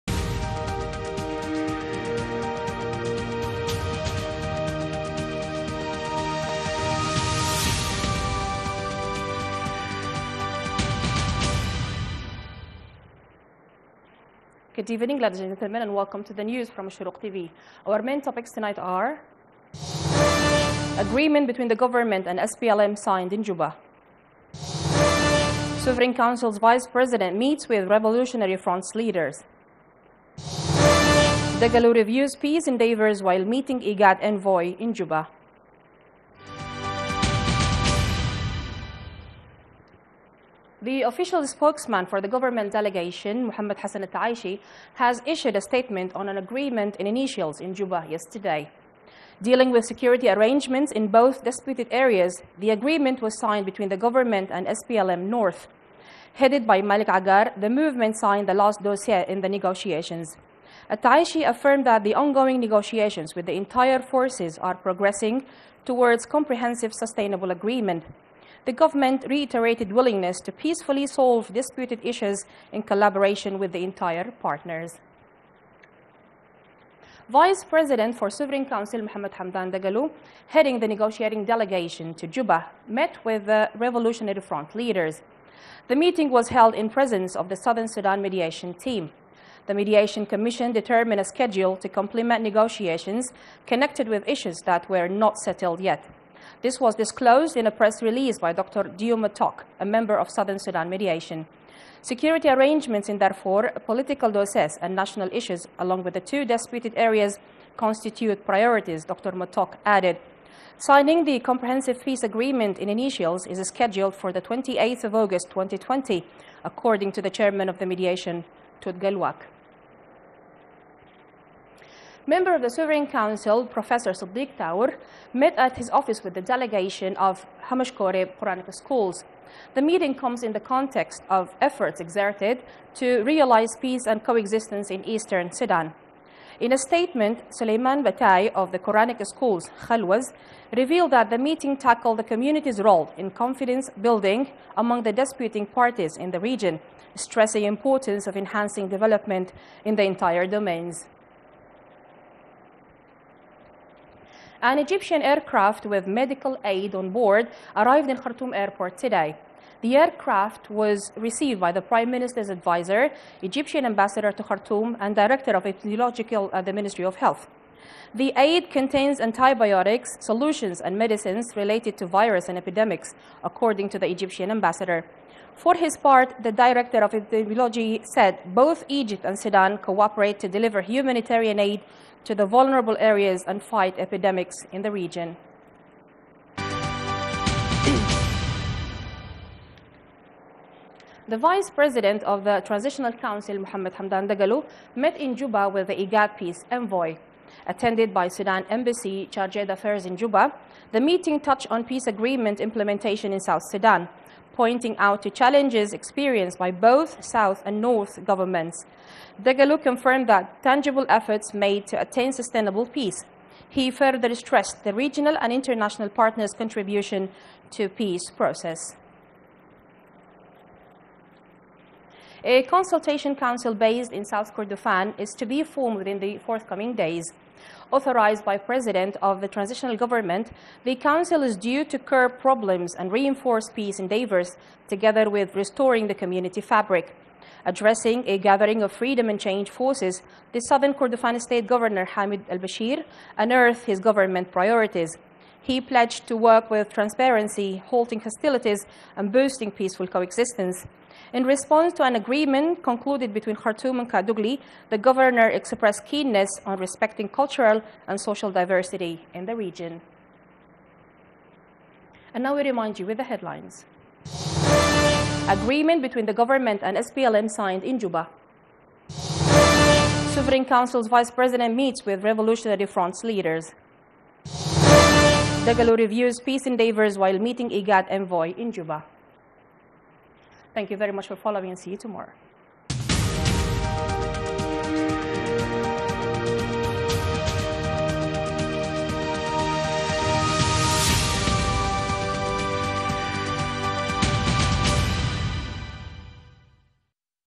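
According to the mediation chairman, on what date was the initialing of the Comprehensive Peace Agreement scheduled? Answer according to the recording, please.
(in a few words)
28 August 2020.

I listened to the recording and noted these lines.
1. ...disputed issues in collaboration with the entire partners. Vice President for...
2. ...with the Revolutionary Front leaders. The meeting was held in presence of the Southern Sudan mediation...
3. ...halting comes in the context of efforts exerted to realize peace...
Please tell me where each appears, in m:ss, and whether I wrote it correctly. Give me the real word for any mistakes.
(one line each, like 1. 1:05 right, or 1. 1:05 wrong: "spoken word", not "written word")
1. 1:11 right
2. 1:23 right
3. 2:09 wrong: "meeting", not "halting".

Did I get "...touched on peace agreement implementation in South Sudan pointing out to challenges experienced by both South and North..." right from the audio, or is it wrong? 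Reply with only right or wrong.
right.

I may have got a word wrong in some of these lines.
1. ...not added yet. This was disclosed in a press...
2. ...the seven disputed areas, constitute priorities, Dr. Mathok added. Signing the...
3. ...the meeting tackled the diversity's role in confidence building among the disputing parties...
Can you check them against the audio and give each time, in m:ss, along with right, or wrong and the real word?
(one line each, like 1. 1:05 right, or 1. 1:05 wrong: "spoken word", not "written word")
1. 1:35 wrong: "settled", not "added"
2. 1:46 wrong: "two", not "seven"
3. 2:21 wrong: "community", not "diversity".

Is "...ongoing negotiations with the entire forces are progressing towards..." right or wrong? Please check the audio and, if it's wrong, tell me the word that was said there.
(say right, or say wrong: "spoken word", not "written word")
right.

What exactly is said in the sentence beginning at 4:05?
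He pledged to work with transparency, halting hostilities, and boosting peaceful coexistence.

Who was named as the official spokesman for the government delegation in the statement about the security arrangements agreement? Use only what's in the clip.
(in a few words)
Mohammed Hassan Al-Taishi.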